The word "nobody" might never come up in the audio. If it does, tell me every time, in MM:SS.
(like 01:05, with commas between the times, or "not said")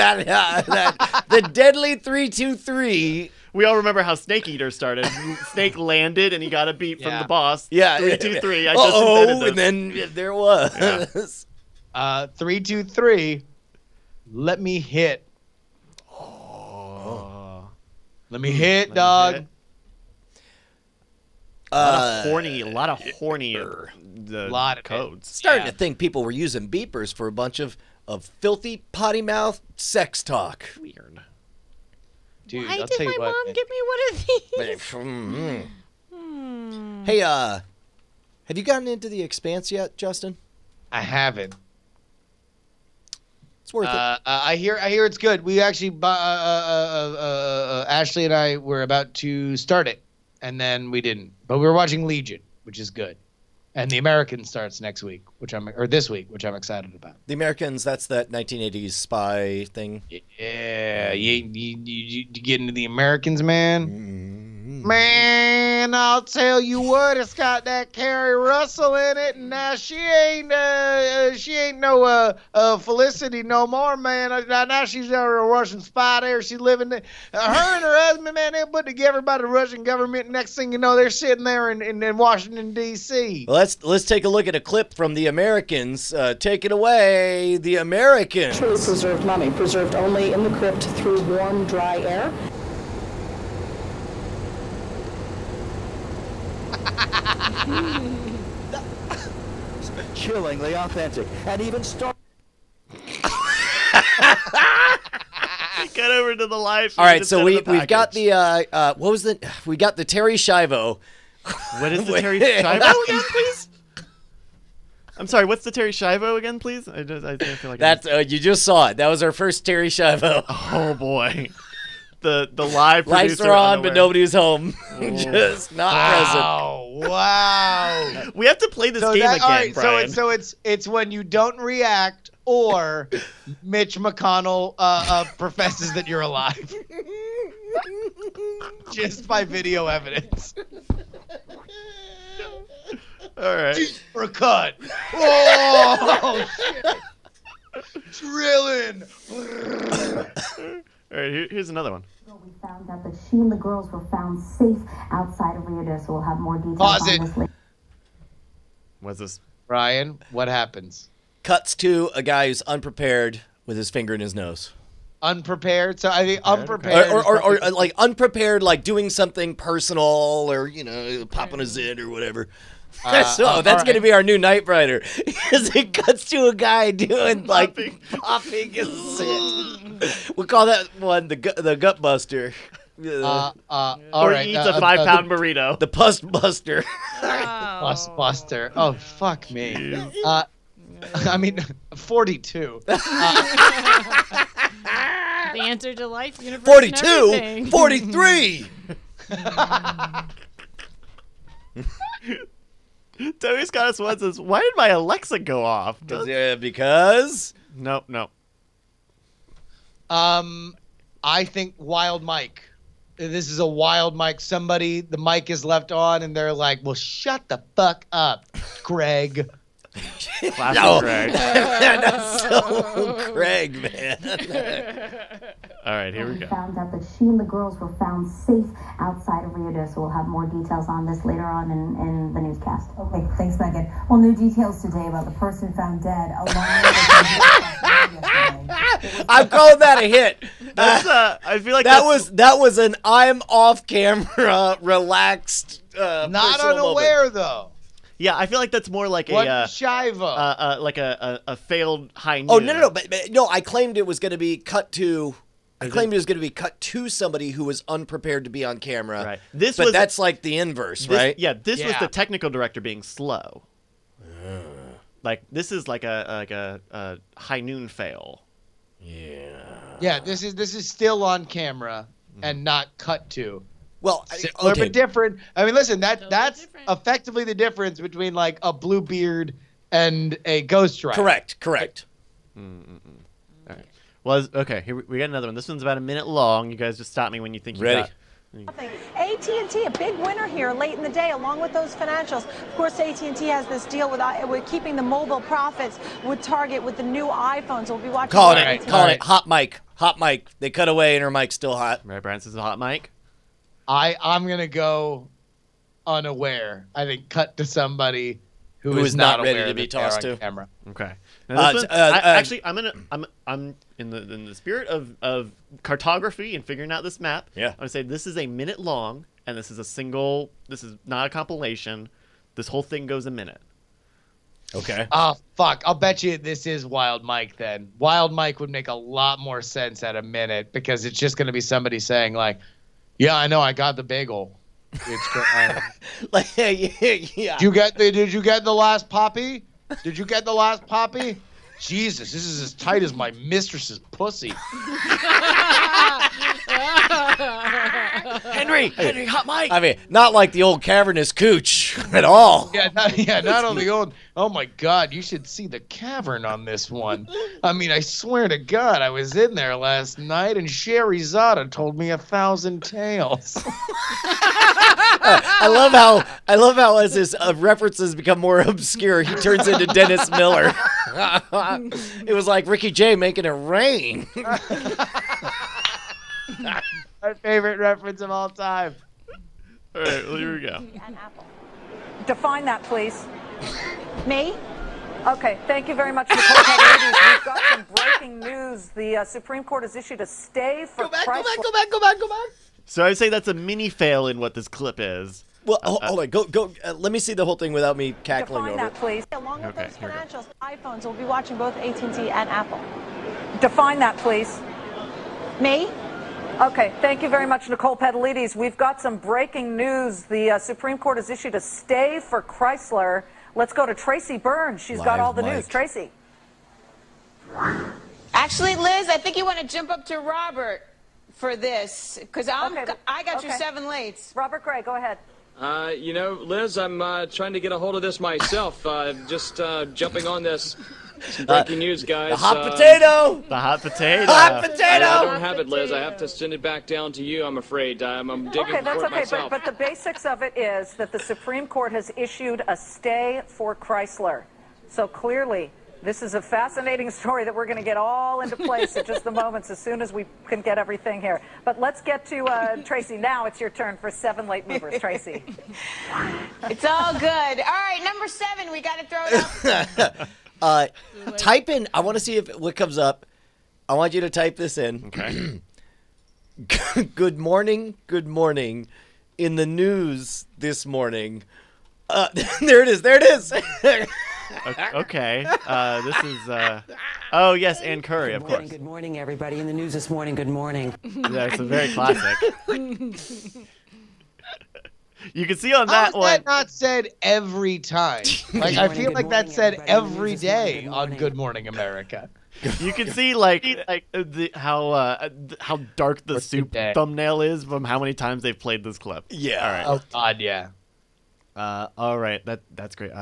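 02:03.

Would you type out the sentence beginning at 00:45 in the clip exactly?
We actually, uh uh, uh, uh, uh, Ashley and I were about to start it, and then we didn't.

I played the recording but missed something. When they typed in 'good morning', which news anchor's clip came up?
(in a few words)
Ann Curry.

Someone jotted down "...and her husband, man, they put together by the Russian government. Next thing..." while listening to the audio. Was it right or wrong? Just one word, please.
right.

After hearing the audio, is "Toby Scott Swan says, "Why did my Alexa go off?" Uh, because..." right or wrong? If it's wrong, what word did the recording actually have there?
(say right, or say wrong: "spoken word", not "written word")
right.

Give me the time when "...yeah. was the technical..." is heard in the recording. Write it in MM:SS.
04:21.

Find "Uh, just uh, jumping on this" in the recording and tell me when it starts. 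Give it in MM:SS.
07:08.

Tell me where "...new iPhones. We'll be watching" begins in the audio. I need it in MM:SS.
04:57.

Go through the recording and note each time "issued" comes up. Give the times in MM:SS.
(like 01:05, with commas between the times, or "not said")
06:29, 06:51, 07:22.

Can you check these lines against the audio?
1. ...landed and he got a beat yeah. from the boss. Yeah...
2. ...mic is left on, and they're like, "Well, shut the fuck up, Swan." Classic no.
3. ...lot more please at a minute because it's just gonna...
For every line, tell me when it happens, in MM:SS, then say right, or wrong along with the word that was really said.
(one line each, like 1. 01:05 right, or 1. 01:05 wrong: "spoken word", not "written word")
1. 00:05 right
2. 03:35 wrong: "Greg", not "Swan"
3. 05:28 wrong: "sense", not "please".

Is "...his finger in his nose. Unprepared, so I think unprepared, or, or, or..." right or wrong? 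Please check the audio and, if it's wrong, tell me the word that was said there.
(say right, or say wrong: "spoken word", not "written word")
right.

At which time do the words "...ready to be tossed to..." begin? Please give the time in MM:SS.
05:09.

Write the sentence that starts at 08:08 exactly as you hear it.
Like morning, I feel like morning, that said every day good on Good Morning America.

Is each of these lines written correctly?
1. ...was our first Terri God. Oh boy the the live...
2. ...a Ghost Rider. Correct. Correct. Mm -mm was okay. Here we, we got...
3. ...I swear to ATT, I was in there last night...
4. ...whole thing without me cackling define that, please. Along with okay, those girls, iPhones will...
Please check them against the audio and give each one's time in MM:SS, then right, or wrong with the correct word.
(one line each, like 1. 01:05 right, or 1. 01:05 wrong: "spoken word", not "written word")
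1. 01:59 wrong: "Schiavo", not "God"
2. 04:40 right
3. 05:57 wrong: "God", not "ATT"
4. 06:37 wrong: "financials", not "girls".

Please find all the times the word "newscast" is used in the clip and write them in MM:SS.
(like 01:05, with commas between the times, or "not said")
03:52.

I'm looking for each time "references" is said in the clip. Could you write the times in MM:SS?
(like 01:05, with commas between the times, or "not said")
06:07, 06:17.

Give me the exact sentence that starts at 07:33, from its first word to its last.
It's your turn for seven late movers, Tracy.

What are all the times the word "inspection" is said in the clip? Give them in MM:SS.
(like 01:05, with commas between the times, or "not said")
not said.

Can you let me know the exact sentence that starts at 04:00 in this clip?
That's, uh, I feel like that was that was an I'm off camera, relaxed, uh, not unaware moment.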